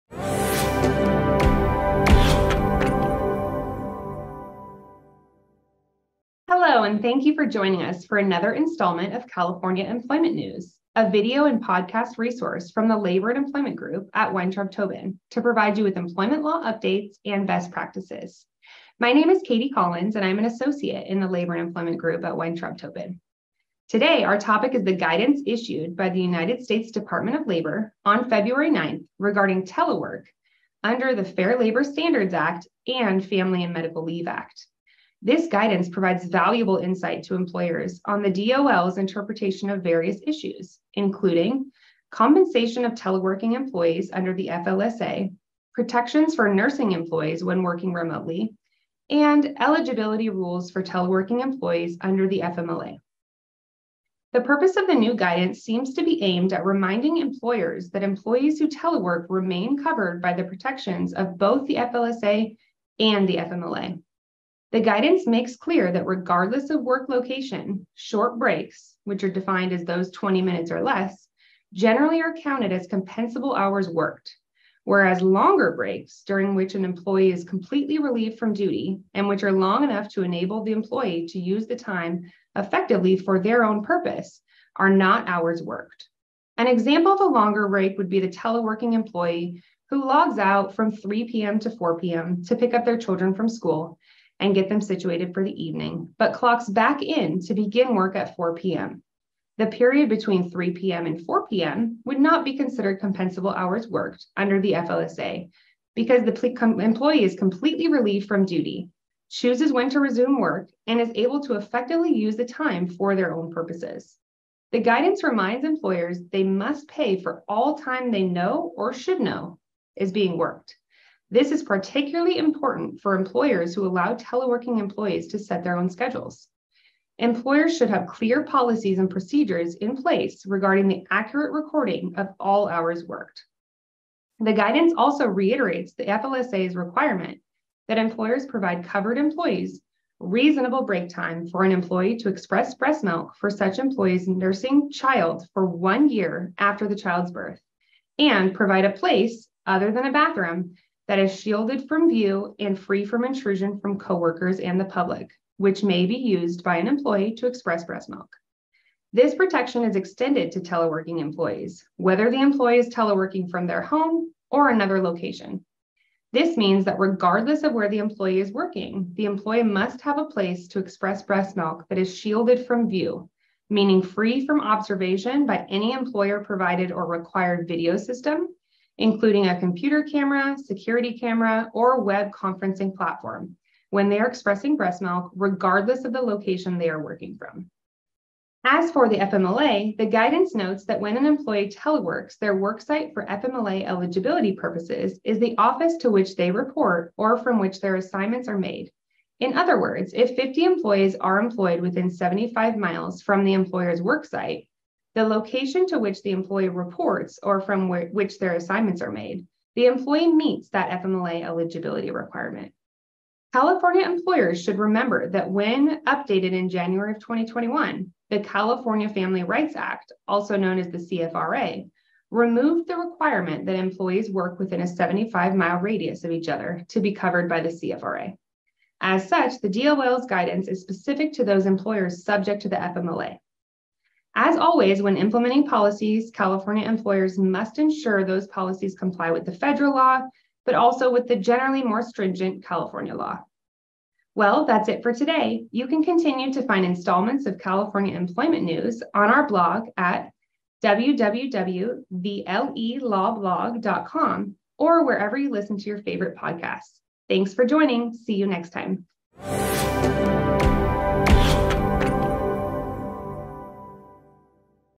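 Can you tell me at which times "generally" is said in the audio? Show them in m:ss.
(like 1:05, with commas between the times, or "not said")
1:11, 4:01.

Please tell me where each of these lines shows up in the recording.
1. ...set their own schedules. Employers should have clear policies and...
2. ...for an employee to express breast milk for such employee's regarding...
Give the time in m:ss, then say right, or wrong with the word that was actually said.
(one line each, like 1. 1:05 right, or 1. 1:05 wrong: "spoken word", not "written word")
1. 2:05 right
2. 2:21 wrong: "nursing", not "regarding".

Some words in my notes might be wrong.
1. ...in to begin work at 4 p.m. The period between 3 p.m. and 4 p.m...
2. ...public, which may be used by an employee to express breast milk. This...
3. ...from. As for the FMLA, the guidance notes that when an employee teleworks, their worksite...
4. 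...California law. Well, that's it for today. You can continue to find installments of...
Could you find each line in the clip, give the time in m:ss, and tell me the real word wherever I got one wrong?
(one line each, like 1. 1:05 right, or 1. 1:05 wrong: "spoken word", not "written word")
1. 1:37 right
2. 2:34 right
3. 3:07 right
4. 4:02 right.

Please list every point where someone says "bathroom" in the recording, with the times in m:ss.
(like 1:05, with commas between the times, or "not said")
2:30.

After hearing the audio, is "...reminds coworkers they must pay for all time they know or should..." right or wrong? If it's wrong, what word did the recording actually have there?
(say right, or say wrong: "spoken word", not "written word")
wrong: "employers", not "coworkers".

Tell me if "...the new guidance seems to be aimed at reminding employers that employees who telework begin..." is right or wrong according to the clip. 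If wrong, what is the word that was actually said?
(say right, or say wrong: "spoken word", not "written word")
wrong: "remain", not "begin".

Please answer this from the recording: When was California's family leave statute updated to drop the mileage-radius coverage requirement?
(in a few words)
January 2021.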